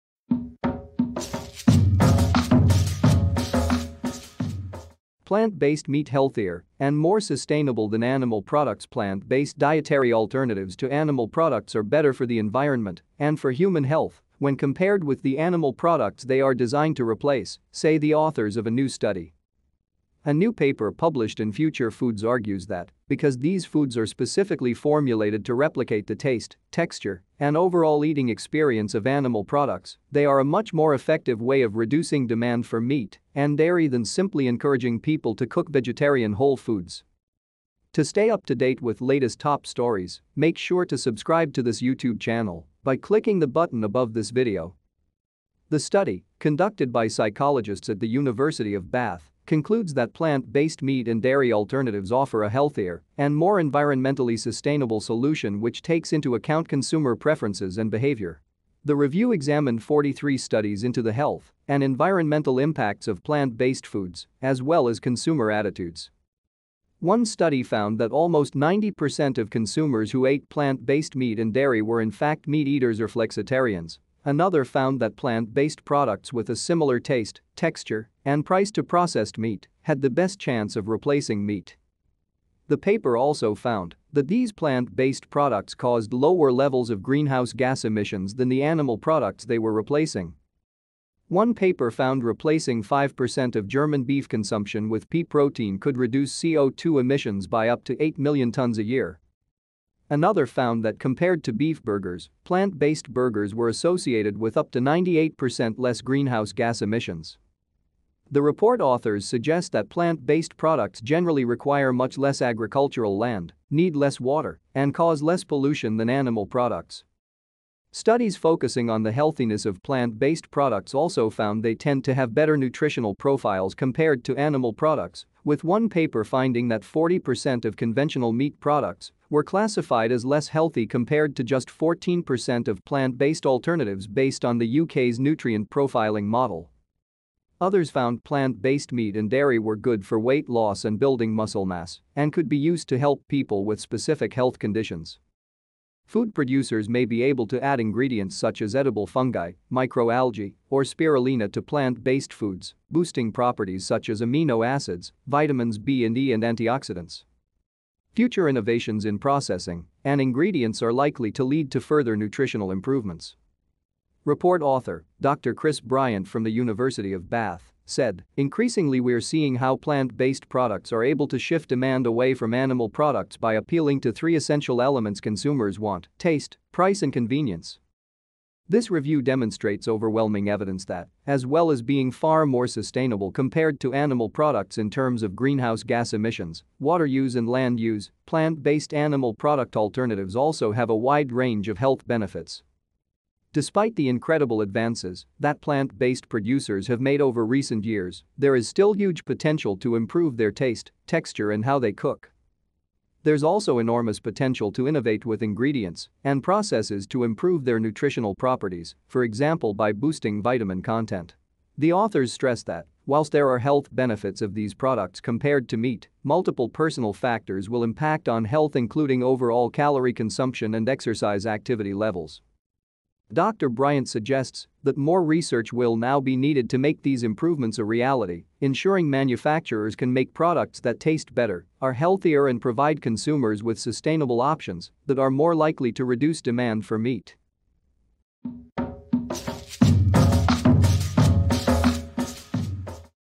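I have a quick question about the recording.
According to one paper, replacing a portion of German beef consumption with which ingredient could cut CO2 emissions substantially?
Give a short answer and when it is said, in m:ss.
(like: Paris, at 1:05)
pea protein, at 1:35.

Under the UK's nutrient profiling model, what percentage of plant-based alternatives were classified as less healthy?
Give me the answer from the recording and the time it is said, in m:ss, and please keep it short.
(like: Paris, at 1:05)
14%, at 2:11.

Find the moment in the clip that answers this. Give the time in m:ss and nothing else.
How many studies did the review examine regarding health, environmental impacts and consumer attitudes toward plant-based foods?
0:59.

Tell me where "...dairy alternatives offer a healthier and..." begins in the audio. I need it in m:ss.
0:51.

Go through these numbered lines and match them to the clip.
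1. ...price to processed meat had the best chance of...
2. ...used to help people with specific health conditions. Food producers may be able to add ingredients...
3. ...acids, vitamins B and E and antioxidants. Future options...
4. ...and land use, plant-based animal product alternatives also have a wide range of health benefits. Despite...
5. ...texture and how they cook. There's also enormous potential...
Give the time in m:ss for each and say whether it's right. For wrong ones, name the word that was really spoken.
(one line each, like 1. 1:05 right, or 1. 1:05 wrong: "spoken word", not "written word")
1. 1:18 right
2. 2:22 right
3. 2:34 wrong: "innovations", not "options"
4. 3:07 right
5. 3:21 right.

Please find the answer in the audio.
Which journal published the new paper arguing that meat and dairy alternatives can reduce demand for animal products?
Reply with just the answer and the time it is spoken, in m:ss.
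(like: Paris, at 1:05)
Future Foods, at 0:21.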